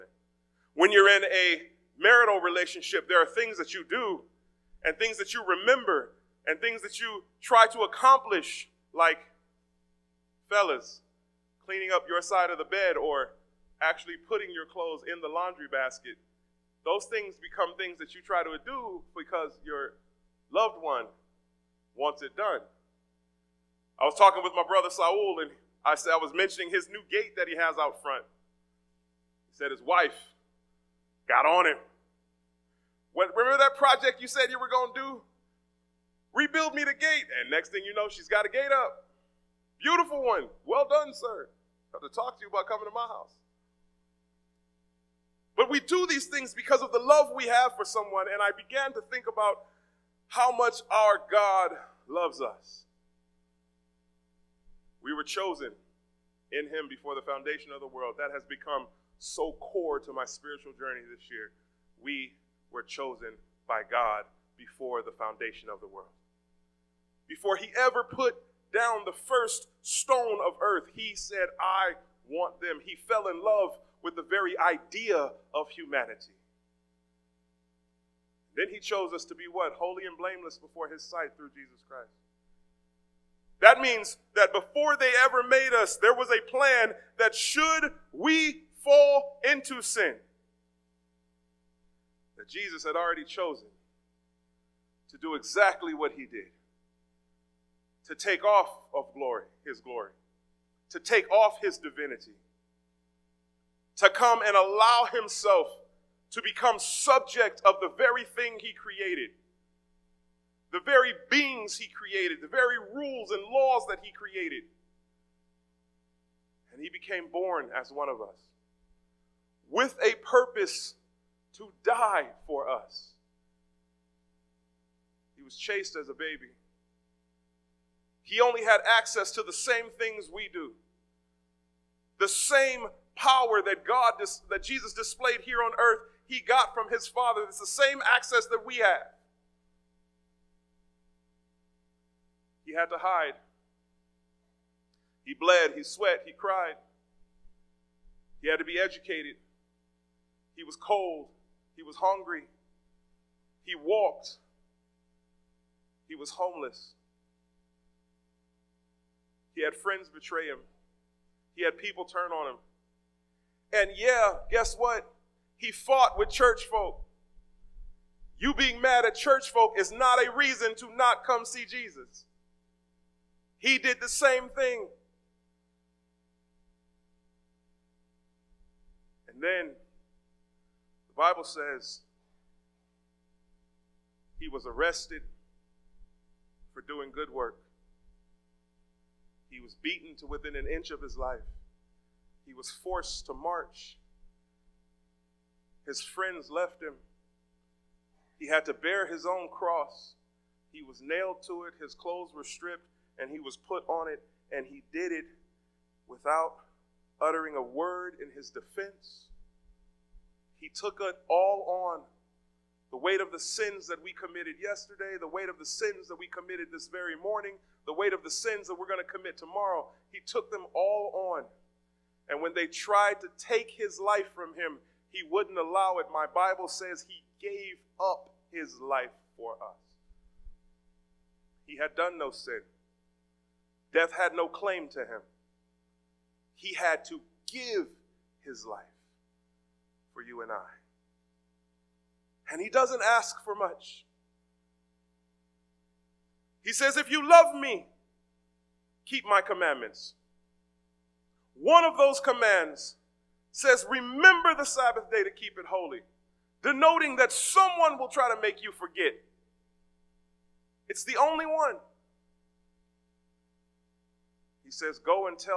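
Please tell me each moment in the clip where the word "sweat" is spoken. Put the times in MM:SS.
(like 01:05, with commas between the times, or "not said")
02:25.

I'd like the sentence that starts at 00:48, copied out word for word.
And I began to think about how much our God loves us.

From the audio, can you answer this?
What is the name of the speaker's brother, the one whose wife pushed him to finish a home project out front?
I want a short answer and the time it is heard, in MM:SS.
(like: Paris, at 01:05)
Saul, at 00:24.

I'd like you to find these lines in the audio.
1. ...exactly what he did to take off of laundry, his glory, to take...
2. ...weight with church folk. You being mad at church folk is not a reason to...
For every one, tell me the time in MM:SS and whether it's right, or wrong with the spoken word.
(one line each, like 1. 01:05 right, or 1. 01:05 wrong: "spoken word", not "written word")
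1. 01:35 wrong: "glory", not "laundry"
2. 02:45 wrong: "fought", not "weight".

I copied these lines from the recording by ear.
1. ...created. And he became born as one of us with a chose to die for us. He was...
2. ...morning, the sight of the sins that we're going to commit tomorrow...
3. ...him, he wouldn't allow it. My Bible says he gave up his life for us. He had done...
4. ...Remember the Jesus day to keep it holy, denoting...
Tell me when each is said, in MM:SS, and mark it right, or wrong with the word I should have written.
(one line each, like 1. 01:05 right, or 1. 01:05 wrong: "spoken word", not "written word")
1. 01:54 wrong: "purpose", not "chose"
2. 03:37 wrong: "weight", not "sight"
3. 03:44 right
4. 04:13 wrong: "Sabbath", not "Jesus".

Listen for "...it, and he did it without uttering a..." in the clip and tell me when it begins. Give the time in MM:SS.
03:24.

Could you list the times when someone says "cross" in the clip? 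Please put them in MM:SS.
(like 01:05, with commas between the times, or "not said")
03:19.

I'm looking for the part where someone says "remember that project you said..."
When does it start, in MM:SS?
00:33.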